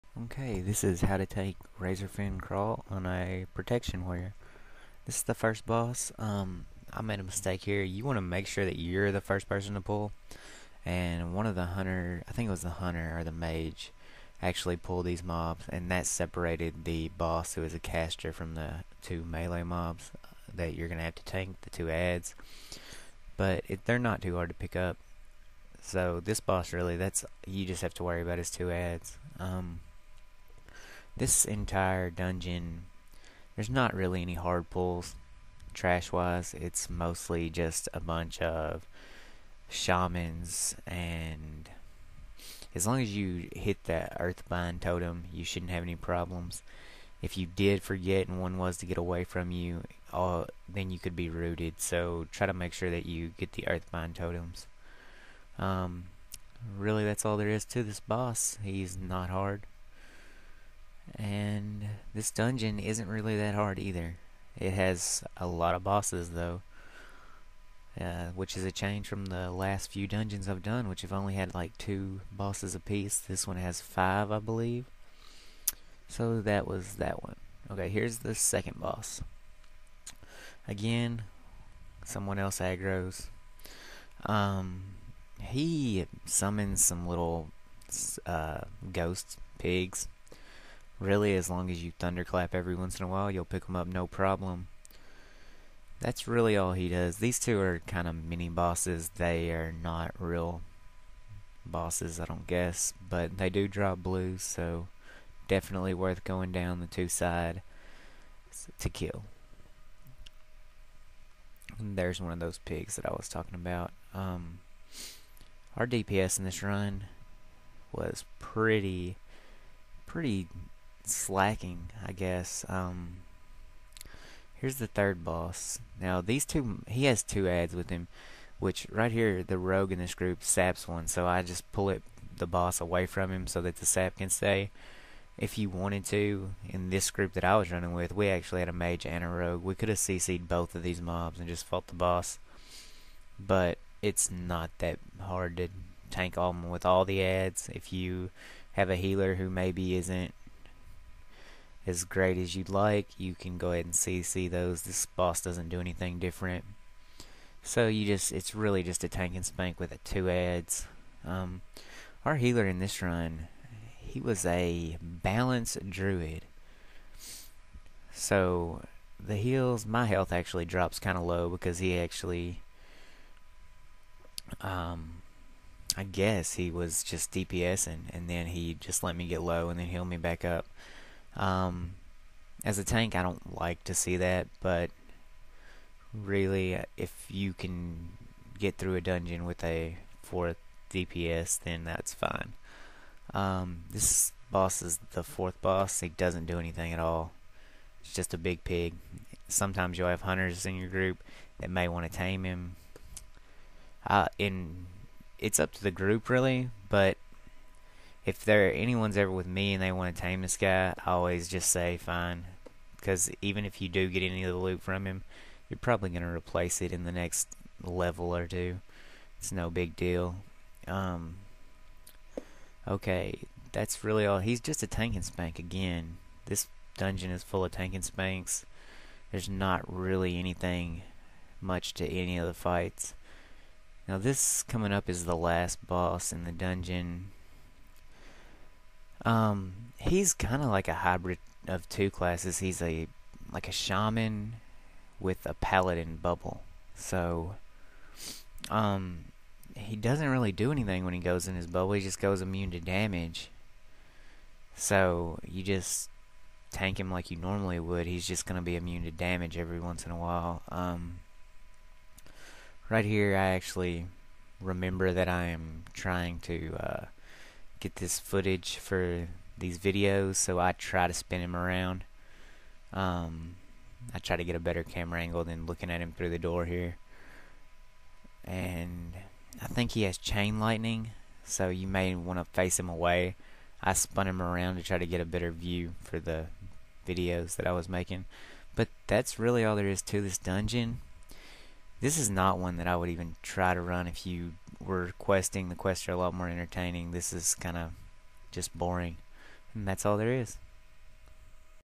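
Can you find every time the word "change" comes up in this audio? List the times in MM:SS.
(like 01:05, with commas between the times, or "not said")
01:08.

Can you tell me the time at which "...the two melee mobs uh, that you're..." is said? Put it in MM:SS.
00:18.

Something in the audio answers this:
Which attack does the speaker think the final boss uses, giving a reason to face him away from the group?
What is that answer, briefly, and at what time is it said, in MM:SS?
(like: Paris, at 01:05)
chain lightning, at 04:40.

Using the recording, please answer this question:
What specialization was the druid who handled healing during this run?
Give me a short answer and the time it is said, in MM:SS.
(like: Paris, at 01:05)
balanced, at 02:45.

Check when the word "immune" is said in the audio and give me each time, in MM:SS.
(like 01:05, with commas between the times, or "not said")
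04:12, 04:18.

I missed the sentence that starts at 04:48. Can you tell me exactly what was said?
But that's really all there is to this dungeon.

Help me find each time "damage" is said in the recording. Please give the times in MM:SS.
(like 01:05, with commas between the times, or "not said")
04:12, 04:19.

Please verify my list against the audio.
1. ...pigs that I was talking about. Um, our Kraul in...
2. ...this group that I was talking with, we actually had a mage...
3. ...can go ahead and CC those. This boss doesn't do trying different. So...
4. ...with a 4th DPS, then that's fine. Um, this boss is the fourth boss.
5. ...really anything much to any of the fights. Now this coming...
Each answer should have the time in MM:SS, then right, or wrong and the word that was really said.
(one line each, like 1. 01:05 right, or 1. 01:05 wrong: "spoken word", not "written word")
1. 01:52 wrong: "DPS", not "Kraul"
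2. 02:16 wrong: "running", not "talking"
3. 02:33 wrong: "anything", not "trying"
4. 03:09 right
5. 03:49 right.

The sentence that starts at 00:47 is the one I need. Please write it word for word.
If you did forget and one was to get away from you, then you could be rooted.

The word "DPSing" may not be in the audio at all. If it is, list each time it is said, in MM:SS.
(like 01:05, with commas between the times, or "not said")
02:57.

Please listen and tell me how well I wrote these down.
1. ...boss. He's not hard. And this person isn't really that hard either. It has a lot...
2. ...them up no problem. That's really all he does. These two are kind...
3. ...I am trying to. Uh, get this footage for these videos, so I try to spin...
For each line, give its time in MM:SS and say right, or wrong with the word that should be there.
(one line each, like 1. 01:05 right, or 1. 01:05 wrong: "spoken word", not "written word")
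1. 00:57 wrong: "dungeon", not "person"
2. 01:33 right
3. 04:25 right.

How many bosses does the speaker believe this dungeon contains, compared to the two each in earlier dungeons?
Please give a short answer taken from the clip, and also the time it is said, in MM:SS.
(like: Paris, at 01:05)
5, at 01:13.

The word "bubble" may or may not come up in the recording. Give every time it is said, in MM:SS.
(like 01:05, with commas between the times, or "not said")
04:06, 04:11.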